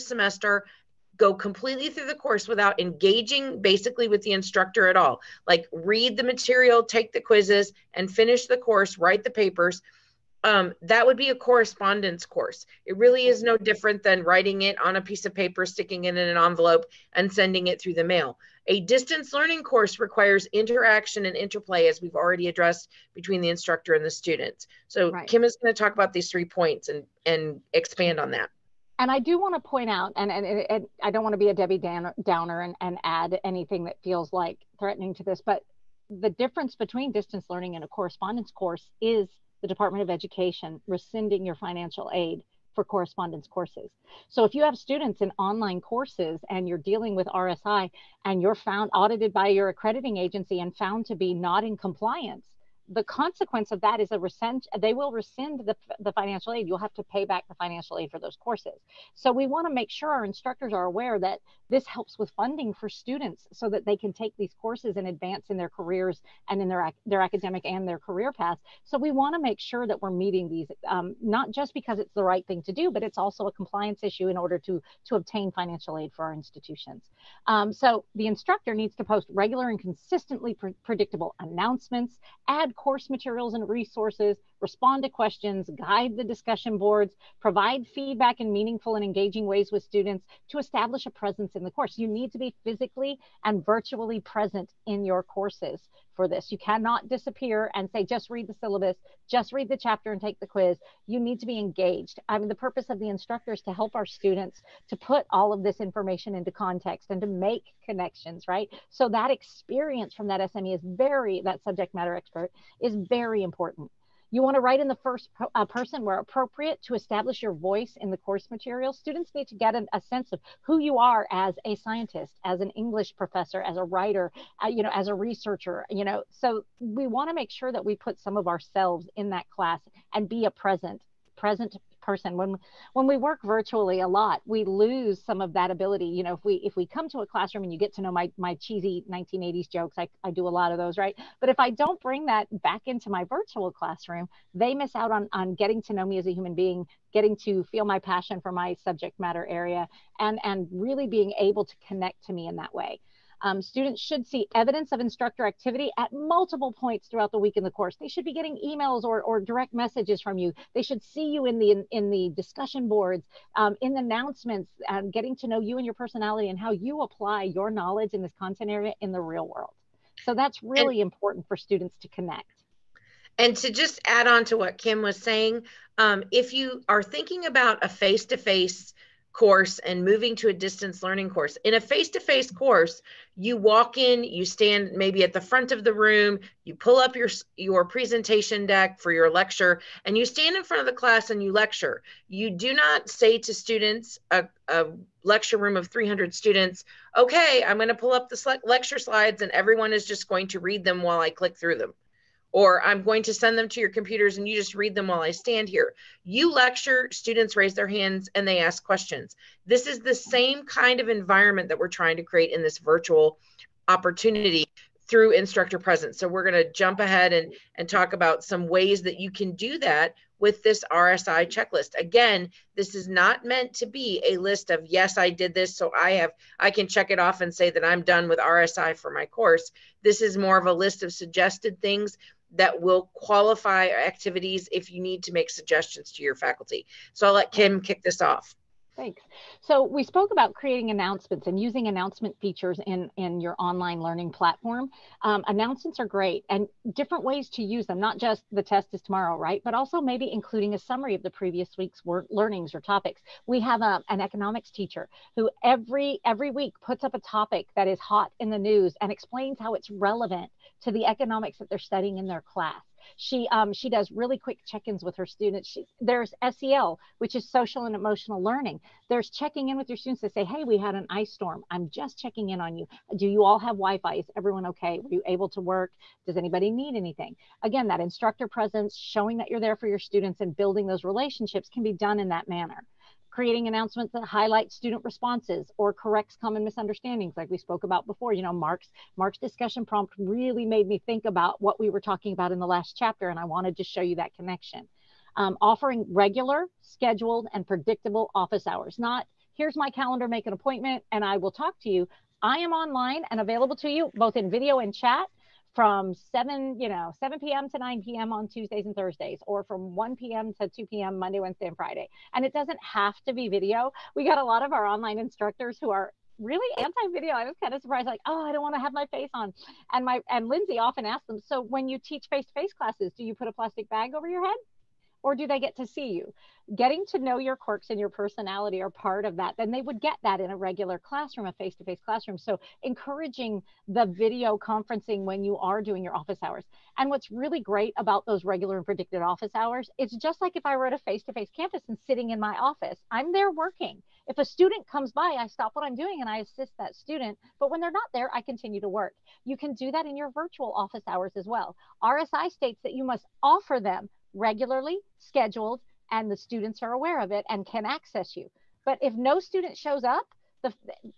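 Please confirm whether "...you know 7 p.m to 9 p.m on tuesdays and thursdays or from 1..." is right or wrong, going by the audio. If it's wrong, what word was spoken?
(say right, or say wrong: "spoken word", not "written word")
right.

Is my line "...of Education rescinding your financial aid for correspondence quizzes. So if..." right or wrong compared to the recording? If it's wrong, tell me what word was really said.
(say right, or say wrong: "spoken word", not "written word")
wrong: "courses", not "quizzes".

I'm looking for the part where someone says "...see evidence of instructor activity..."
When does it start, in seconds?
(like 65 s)
154 s.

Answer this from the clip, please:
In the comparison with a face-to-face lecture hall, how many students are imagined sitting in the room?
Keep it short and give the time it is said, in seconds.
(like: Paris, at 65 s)
300, at 195 s.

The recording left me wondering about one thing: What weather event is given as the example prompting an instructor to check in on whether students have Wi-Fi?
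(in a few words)
an ice storm.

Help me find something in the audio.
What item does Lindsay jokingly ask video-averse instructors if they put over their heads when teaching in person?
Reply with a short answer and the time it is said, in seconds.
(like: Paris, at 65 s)
a plastic bag, at 323 s.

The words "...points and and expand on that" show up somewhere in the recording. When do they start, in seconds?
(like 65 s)
26 s.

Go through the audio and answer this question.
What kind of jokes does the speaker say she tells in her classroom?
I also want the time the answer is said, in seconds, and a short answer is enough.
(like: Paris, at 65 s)
cheesy 1980s jokes, at 138 s.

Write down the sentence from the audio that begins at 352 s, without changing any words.
RSI states that you must offer them regularly scheduled and the students are aware of it and can access you.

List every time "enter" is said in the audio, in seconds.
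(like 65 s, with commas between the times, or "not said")
not said.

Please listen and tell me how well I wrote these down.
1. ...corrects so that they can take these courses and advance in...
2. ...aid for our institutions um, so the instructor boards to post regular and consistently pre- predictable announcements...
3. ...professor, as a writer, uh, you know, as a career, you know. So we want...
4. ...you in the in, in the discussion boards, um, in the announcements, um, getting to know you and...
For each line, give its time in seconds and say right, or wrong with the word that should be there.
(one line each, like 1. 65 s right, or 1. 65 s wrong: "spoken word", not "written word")
1. 62 s wrong: "students", not "corrects"
2. 75 s wrong: "needs", not "boards"
3. 123 s wrong: "researcher", not "career"
4. 161 s right.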